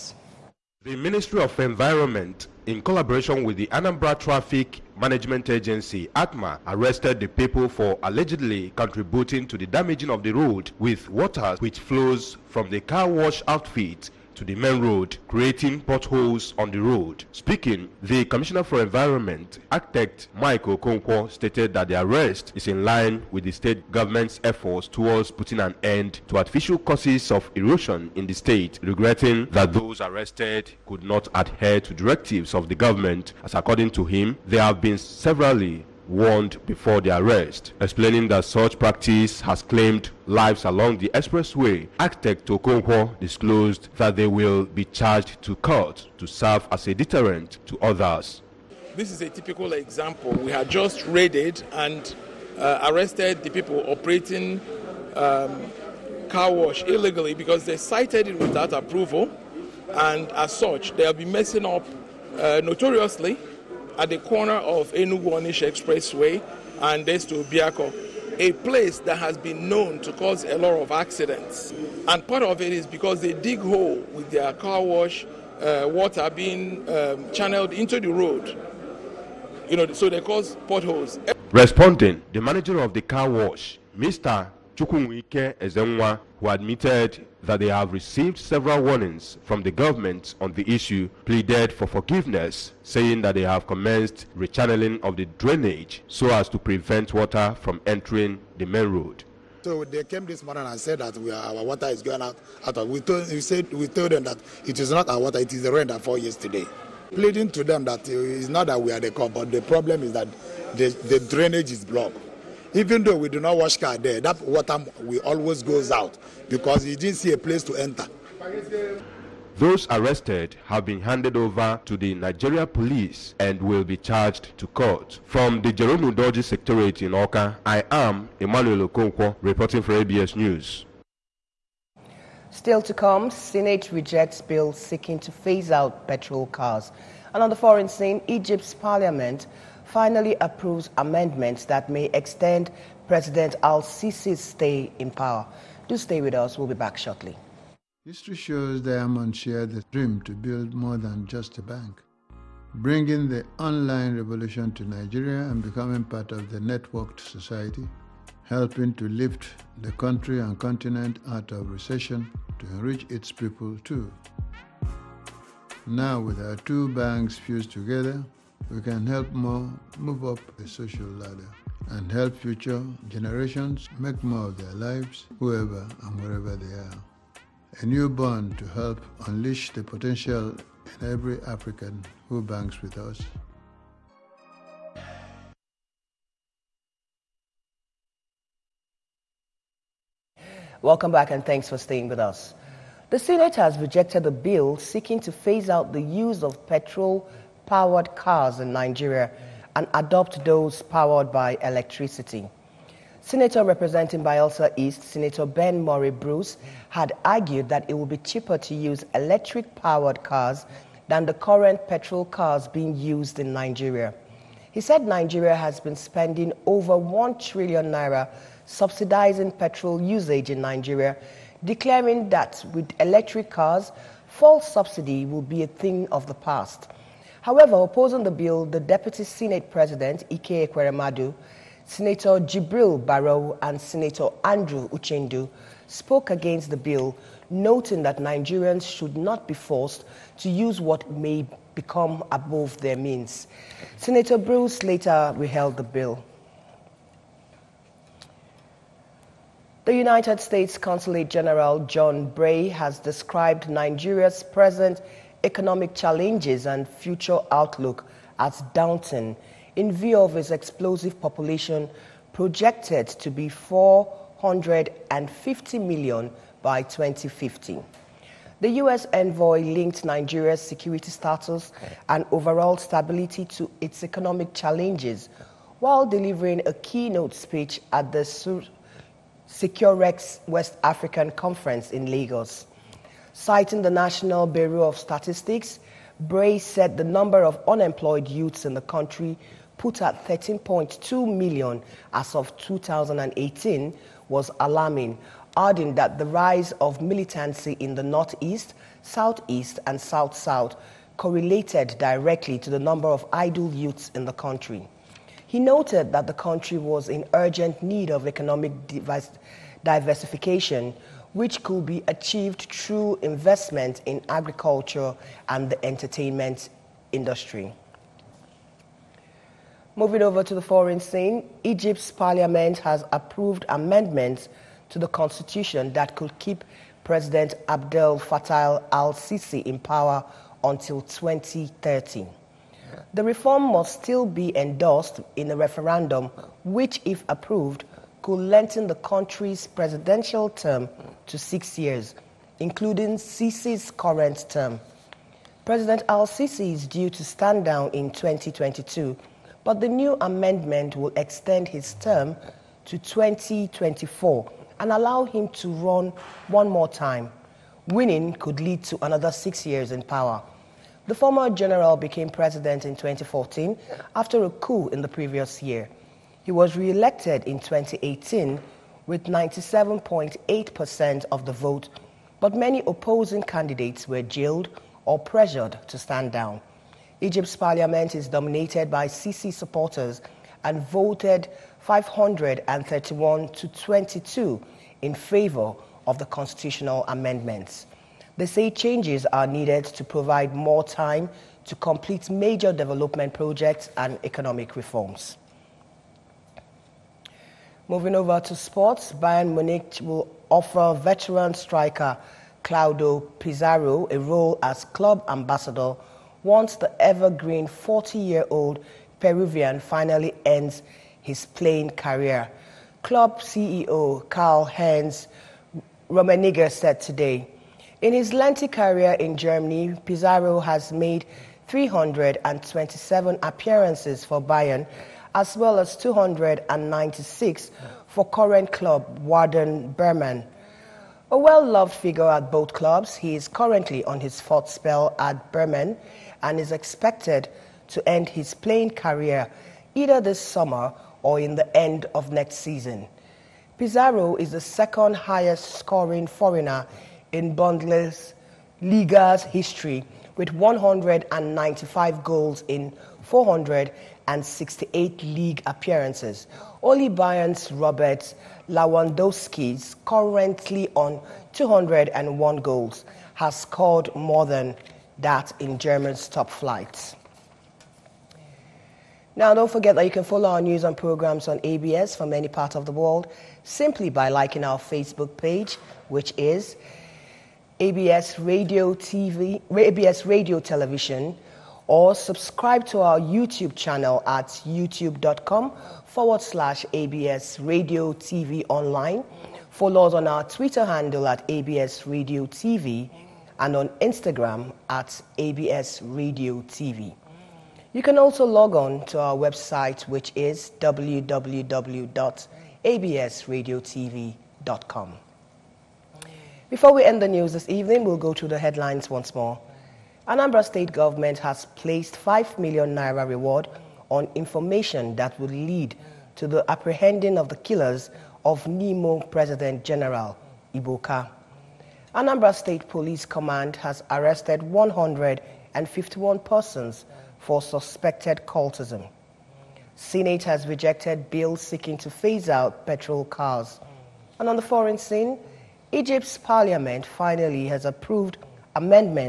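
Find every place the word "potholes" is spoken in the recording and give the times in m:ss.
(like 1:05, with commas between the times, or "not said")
0:15, 1:20.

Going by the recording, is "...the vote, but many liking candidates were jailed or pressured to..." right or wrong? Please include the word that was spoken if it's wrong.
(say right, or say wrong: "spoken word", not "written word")
wrong: "opposing", not "liking".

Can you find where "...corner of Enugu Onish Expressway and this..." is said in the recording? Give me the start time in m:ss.
1:04.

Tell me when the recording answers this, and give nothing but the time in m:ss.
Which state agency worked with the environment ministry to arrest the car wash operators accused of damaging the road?
0:03.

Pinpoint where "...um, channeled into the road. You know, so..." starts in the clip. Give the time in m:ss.
1:16.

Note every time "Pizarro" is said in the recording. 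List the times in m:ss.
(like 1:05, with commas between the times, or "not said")
6:43, 7:00, 7:23.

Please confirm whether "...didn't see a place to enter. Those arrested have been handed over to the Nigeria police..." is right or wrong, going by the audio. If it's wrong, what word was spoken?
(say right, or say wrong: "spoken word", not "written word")
right.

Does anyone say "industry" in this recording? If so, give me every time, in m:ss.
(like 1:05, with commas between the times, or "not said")
5:17.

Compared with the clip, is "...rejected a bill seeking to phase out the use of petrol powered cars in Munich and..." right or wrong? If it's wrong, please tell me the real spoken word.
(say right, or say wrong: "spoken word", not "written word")
wrong: "Nigeria", not "Munich".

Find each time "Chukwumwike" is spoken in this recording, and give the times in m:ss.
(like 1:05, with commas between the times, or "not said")
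1:24.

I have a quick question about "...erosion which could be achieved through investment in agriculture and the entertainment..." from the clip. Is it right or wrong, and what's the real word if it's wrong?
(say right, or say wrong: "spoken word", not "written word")
wrong: "diversification", not "erosion".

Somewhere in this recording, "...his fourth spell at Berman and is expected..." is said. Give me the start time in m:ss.
7:14.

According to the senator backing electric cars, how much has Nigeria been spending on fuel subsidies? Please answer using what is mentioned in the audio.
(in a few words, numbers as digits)
over 1 trillion naira.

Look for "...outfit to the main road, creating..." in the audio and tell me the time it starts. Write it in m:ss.
0:13.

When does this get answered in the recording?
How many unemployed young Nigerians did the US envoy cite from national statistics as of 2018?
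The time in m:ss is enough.
4:50.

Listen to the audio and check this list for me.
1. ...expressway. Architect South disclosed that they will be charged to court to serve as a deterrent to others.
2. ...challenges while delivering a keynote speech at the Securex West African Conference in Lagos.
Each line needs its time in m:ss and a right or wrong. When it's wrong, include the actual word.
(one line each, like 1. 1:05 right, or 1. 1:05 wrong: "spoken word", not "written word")
1. 0:41 wrong: "Okonkwo", not "South"
2. 4:34 right.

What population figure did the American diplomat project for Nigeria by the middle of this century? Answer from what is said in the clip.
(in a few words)
450 million.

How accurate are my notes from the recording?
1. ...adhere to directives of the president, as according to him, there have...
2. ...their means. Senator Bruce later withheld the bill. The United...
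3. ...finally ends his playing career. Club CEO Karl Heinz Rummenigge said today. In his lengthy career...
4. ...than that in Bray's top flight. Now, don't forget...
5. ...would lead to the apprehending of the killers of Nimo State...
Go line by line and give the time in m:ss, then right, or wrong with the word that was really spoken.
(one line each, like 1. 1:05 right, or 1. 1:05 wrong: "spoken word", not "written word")
1. 0:31 wrong: "government", not "president"
2. 4:02 right
3. 6:49 right
4. 7:44 wrong: "Germany", not "Bray"
5. 8:35 wrong: "President", not "State".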